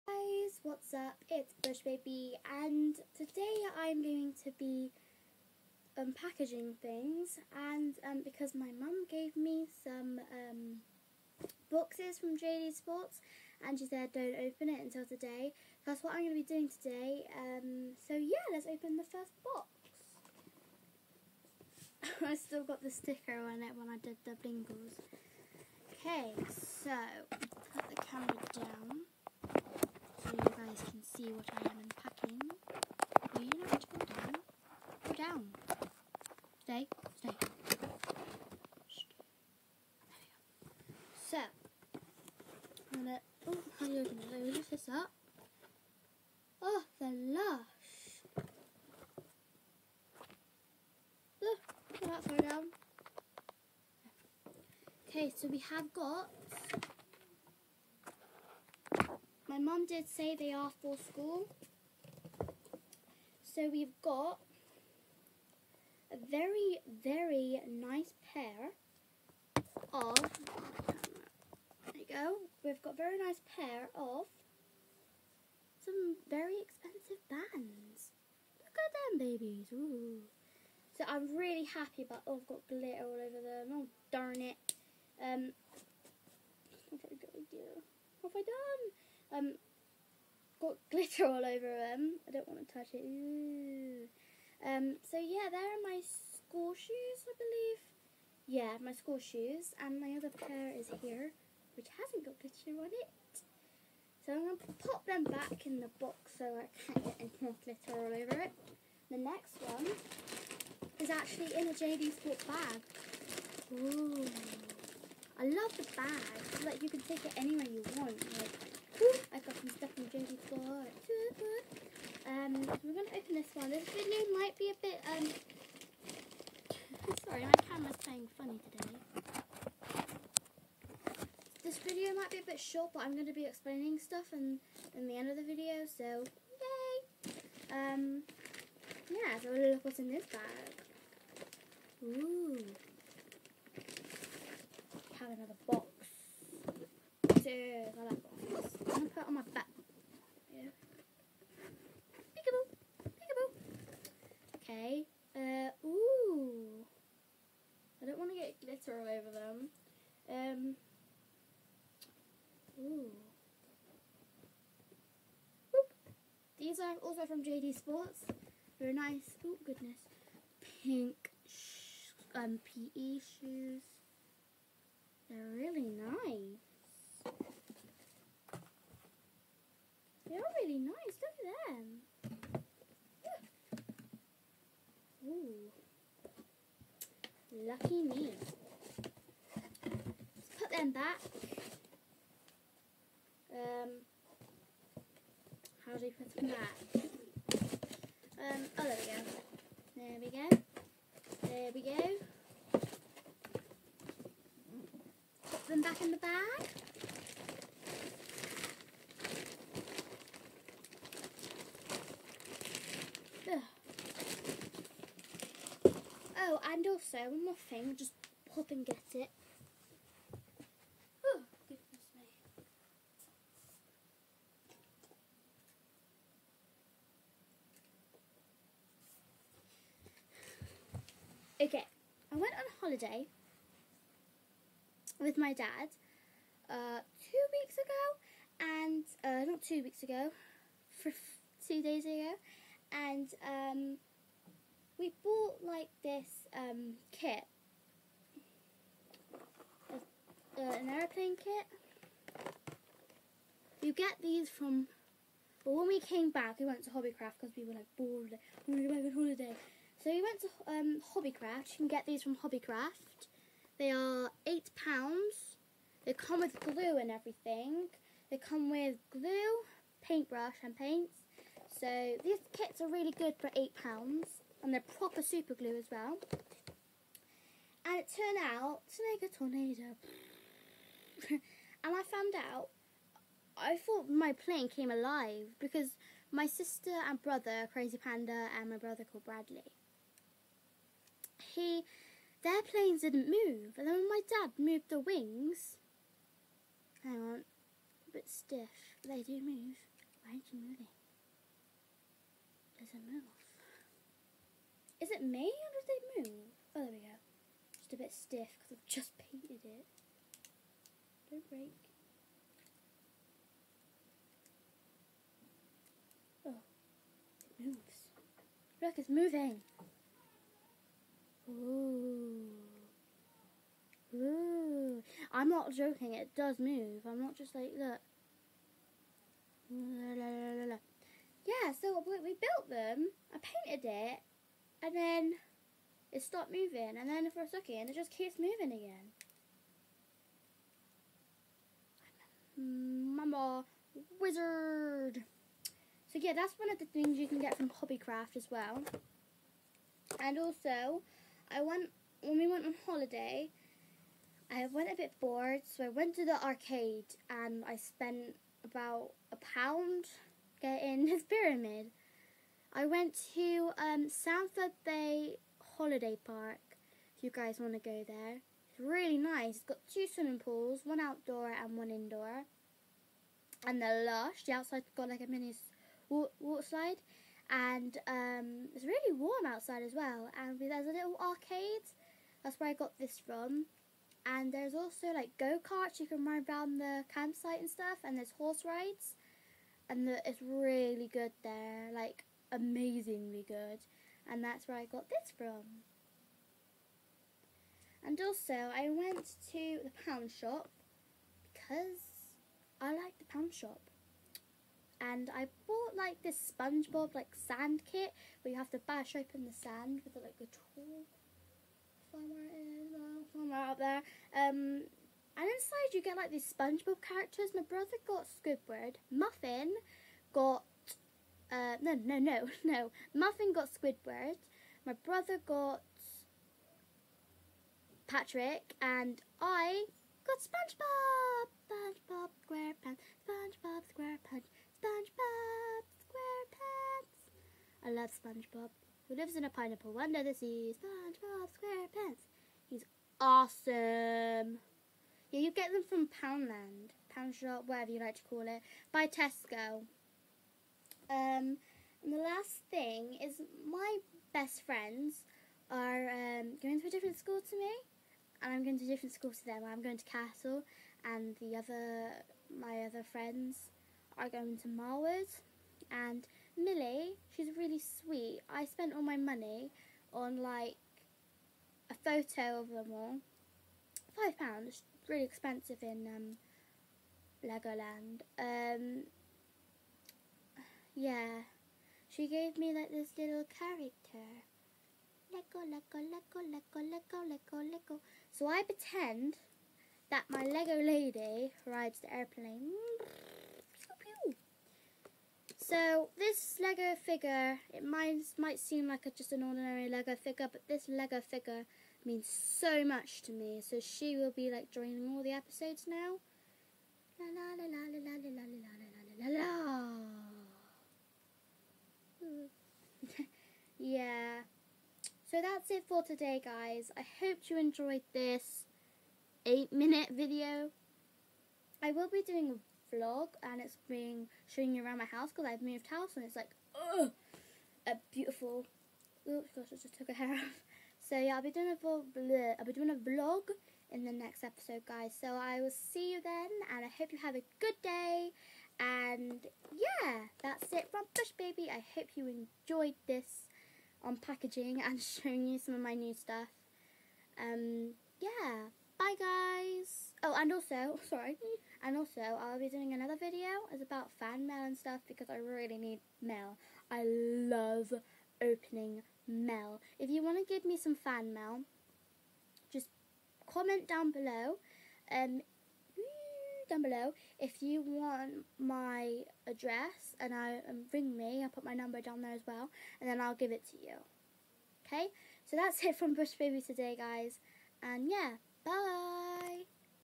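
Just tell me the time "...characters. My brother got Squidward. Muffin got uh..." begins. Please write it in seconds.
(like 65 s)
417 s.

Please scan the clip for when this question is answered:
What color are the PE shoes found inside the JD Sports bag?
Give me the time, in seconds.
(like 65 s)
170 s.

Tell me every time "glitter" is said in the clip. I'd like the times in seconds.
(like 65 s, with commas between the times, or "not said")
82 s, 90 s, 102 s, 107 s, 158 s.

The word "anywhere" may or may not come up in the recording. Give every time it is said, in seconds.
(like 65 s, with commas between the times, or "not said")
117 s.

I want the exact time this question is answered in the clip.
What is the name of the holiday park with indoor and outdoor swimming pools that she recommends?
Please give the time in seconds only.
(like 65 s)
364 s.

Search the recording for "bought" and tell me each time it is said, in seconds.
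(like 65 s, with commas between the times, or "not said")
245 s, 405 s.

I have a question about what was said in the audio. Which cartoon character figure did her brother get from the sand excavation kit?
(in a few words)
Patrick.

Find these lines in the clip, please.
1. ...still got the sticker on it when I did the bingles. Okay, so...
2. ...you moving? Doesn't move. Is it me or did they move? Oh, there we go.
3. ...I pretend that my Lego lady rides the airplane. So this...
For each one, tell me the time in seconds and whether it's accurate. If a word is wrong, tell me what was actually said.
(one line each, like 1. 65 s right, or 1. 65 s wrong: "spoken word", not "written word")
1. 22 s right
2. 300 s right
3. 488 s right.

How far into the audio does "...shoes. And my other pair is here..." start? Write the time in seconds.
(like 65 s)
99 s.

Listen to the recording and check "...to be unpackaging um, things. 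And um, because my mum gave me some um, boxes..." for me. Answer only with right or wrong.
right.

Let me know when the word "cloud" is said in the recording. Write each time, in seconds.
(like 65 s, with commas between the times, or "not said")
not said.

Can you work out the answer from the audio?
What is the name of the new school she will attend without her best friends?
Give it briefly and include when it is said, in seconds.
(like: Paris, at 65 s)
Castle, at 460 s.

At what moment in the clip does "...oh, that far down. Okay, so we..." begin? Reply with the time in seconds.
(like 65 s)
52 s.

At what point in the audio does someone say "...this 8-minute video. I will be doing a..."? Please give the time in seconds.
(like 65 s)
518 s.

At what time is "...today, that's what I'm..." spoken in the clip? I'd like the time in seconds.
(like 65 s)
15 s.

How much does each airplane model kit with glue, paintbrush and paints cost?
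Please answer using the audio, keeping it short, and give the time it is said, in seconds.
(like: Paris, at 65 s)
£8, at 273 s.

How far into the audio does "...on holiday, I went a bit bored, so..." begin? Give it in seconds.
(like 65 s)
352 s.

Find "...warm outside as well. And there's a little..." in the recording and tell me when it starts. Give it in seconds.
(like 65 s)
379 s.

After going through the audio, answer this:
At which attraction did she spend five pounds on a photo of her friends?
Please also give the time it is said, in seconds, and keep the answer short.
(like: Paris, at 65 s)
Legoland, at 477 s.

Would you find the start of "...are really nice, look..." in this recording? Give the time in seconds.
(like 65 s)
180 s.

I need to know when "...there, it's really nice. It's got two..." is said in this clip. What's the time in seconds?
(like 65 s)
368 s.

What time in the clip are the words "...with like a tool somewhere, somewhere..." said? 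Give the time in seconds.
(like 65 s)
410 s.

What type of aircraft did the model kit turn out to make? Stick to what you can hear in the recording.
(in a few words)
Tornado.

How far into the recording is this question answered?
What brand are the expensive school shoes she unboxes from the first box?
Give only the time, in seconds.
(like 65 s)
77 s.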